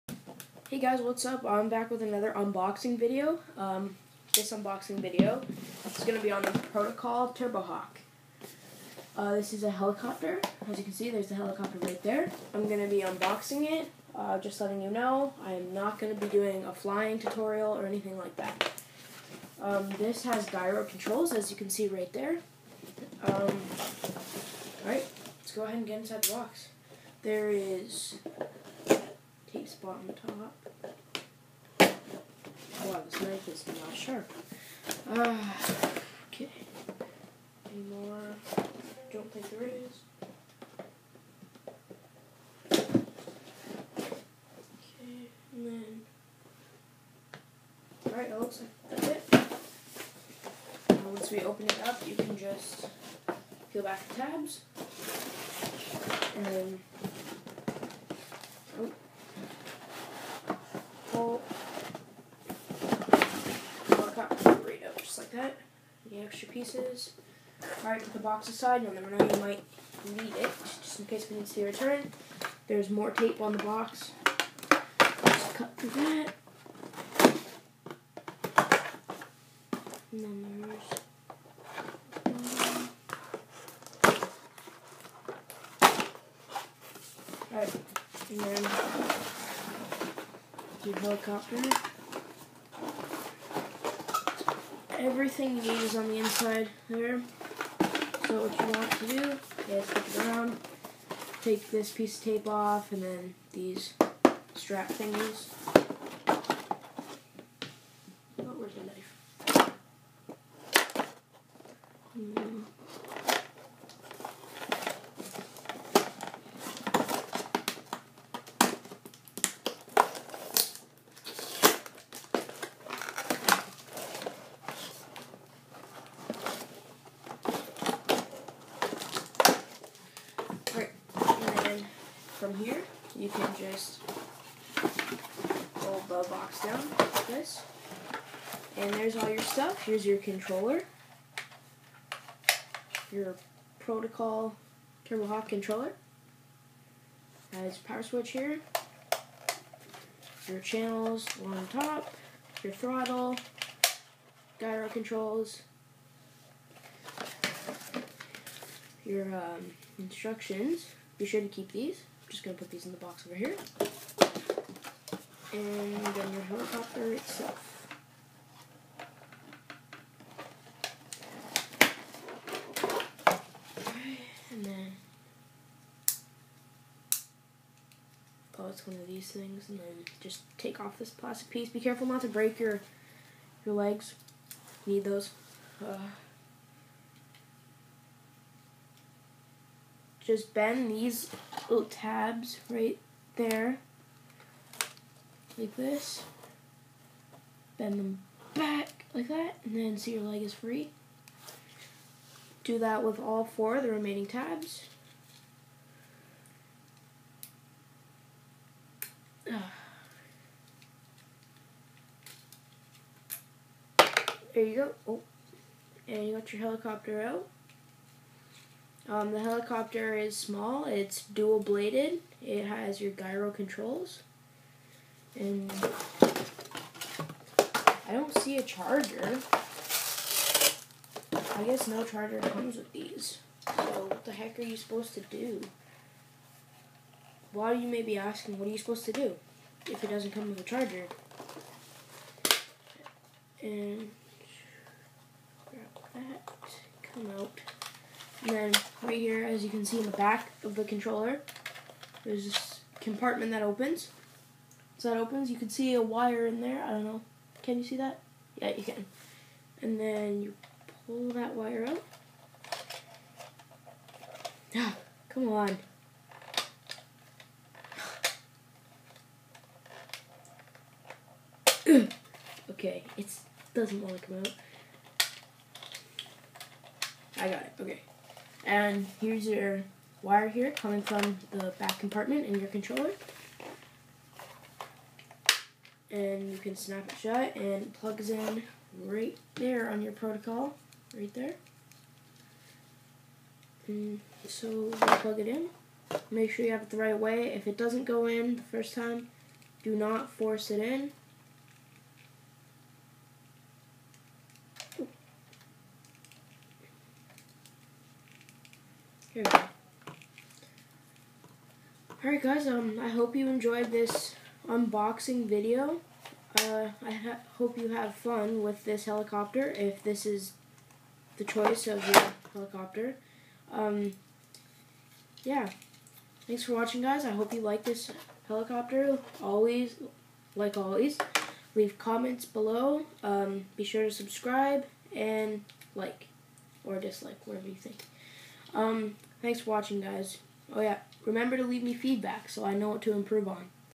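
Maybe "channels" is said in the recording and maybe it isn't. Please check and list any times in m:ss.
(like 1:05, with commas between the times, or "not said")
2:30.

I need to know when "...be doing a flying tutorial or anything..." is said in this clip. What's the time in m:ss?
0:16.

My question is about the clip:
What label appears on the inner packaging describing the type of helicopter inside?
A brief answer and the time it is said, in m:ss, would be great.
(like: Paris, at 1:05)
rescue helicopter, at 1:30.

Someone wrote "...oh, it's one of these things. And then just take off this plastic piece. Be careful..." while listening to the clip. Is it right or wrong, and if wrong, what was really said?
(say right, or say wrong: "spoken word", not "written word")
right.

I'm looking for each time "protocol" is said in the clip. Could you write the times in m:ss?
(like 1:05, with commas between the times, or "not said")
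0:06, 2:23, 4:50.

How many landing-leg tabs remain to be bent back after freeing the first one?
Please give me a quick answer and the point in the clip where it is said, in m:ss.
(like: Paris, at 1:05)
4, at 3:23.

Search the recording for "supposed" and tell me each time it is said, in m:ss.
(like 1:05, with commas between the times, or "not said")
3:54, 3:58.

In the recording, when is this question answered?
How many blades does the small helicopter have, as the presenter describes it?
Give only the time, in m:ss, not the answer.
3:41.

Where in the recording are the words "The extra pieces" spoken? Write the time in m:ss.
1:06.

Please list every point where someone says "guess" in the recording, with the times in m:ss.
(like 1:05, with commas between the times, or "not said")
3:51.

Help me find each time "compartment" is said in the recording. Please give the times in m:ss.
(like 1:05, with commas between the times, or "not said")
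4:12, 4:41.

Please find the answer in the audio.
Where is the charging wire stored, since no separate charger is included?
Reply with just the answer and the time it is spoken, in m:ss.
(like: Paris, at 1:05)
back of the controller, at 4:10.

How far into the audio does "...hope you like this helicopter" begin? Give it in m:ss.
5:27.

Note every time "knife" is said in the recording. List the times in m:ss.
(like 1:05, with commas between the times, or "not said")
0:33, 1:49.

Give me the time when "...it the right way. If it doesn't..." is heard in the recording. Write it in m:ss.
4:56.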